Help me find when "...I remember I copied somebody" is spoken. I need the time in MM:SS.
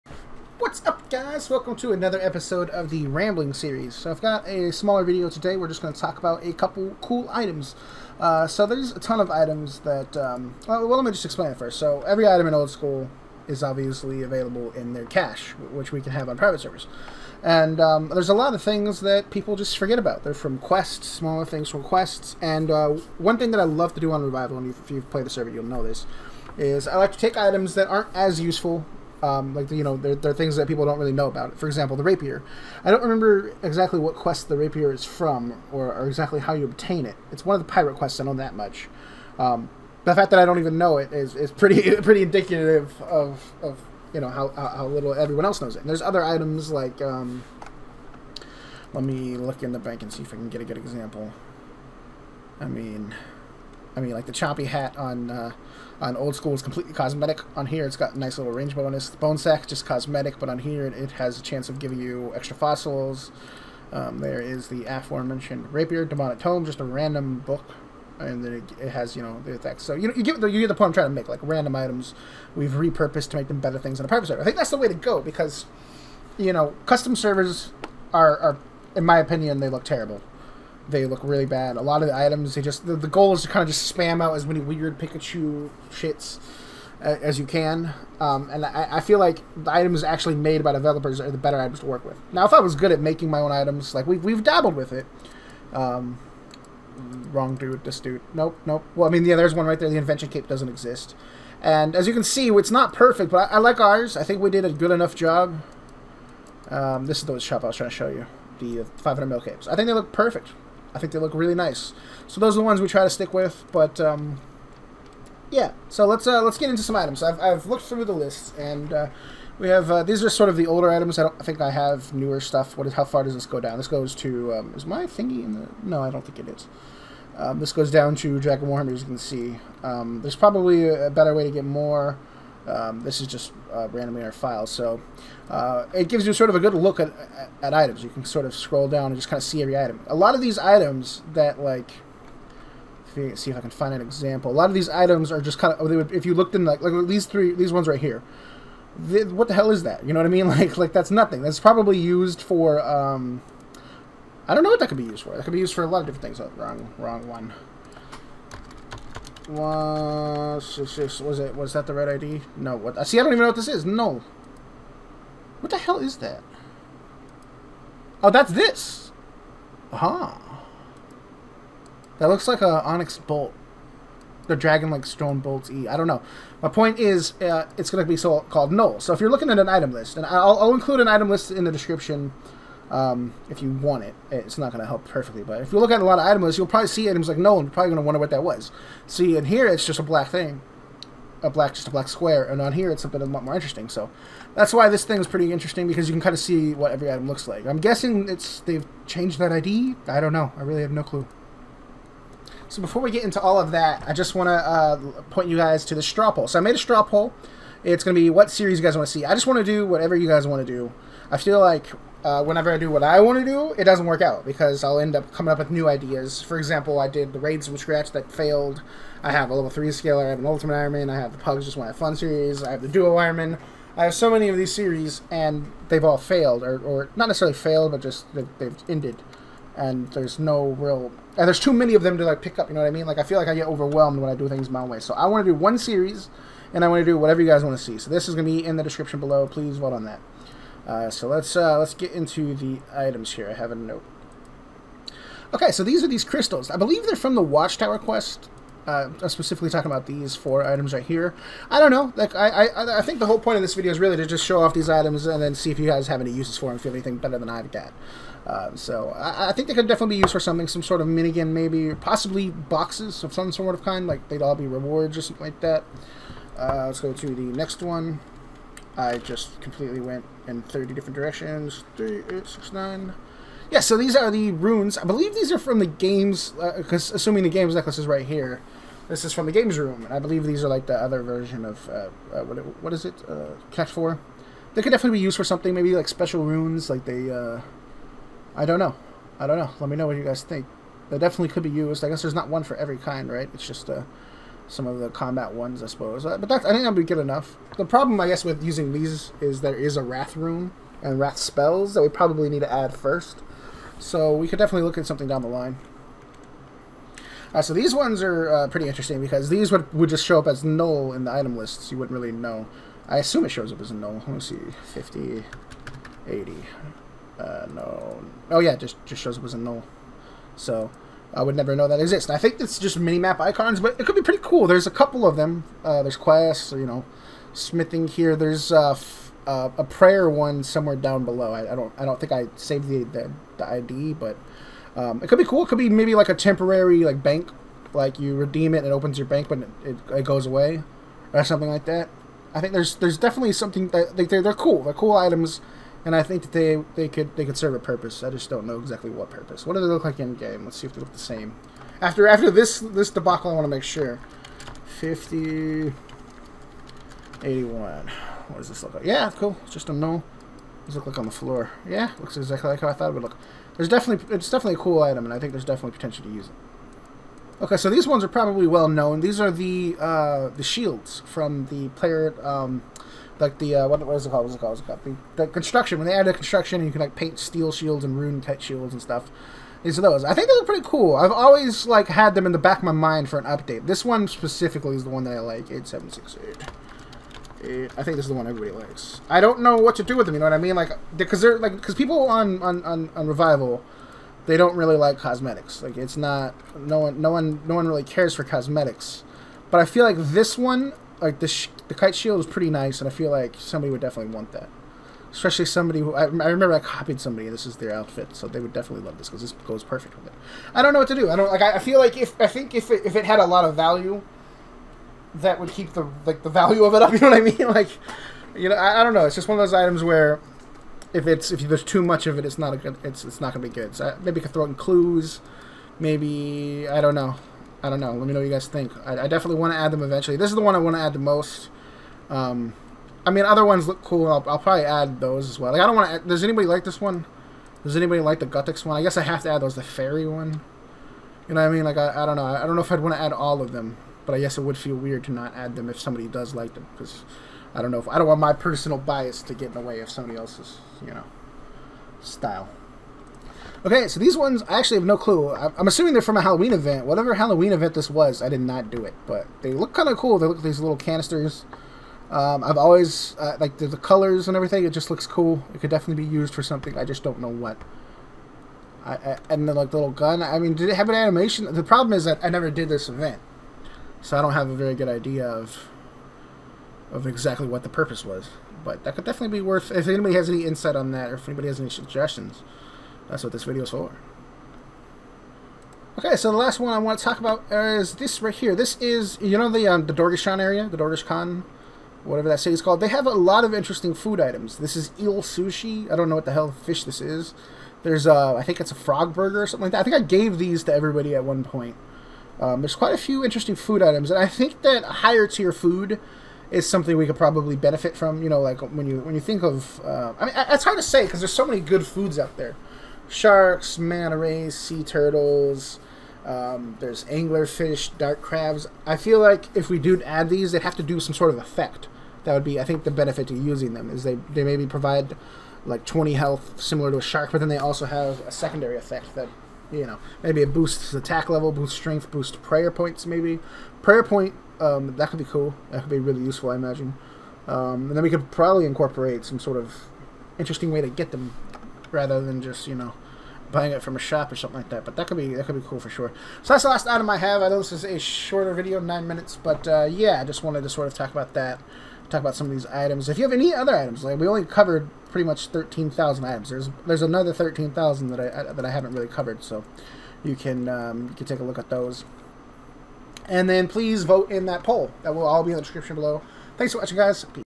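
06:46.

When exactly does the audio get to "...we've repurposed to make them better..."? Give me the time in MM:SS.
01:12.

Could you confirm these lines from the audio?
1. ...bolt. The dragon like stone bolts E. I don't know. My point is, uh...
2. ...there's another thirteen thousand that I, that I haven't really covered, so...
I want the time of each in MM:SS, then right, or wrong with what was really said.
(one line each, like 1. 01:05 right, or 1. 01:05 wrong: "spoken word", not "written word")
1. 02:53 right
2. 09:17 right.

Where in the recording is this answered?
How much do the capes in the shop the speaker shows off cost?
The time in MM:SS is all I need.
01:48.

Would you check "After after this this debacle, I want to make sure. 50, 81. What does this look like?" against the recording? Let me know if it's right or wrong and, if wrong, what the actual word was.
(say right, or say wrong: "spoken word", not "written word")
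right.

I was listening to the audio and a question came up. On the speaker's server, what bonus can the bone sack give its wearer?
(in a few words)
Extra fossils.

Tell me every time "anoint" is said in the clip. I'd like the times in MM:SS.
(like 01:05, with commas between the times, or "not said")
not said.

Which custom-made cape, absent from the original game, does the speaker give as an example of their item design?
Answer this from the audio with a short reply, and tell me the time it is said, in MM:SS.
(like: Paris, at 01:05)
Invention cape, at 01:39.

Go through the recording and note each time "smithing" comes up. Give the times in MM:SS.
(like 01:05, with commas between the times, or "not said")
05:27.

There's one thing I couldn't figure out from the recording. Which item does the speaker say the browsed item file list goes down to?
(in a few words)
Dragon Warhammer.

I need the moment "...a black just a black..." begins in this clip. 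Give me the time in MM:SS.
03:11.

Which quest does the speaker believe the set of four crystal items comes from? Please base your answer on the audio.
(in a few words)
Watchtower quest.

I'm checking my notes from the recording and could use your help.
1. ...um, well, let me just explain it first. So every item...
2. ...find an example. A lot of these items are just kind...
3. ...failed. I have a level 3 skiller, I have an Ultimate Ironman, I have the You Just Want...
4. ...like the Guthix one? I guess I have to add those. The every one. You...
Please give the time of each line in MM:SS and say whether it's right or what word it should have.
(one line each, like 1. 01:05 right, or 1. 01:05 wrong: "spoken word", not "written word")
1. 00:10 right
2. 02:23 right
3. 03:38 wrong: "Pugs", not "You"
4. 07:18 wrong: "fairy", not "every".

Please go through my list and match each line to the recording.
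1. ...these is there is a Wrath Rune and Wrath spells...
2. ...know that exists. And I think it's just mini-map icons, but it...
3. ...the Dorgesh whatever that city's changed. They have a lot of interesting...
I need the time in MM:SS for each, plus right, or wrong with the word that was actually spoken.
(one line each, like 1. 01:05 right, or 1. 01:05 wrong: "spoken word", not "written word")
1. 04:58 right
2. 05:21 right
3. 08:10 wrong: "called", not "changed".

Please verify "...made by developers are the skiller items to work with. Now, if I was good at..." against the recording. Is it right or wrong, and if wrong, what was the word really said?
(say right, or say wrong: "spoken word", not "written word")
wrong: "better", not "skiller".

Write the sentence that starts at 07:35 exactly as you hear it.
I'm assuming they're from a Halloween event.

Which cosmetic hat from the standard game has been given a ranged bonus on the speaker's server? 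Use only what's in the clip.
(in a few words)
Choppy hat.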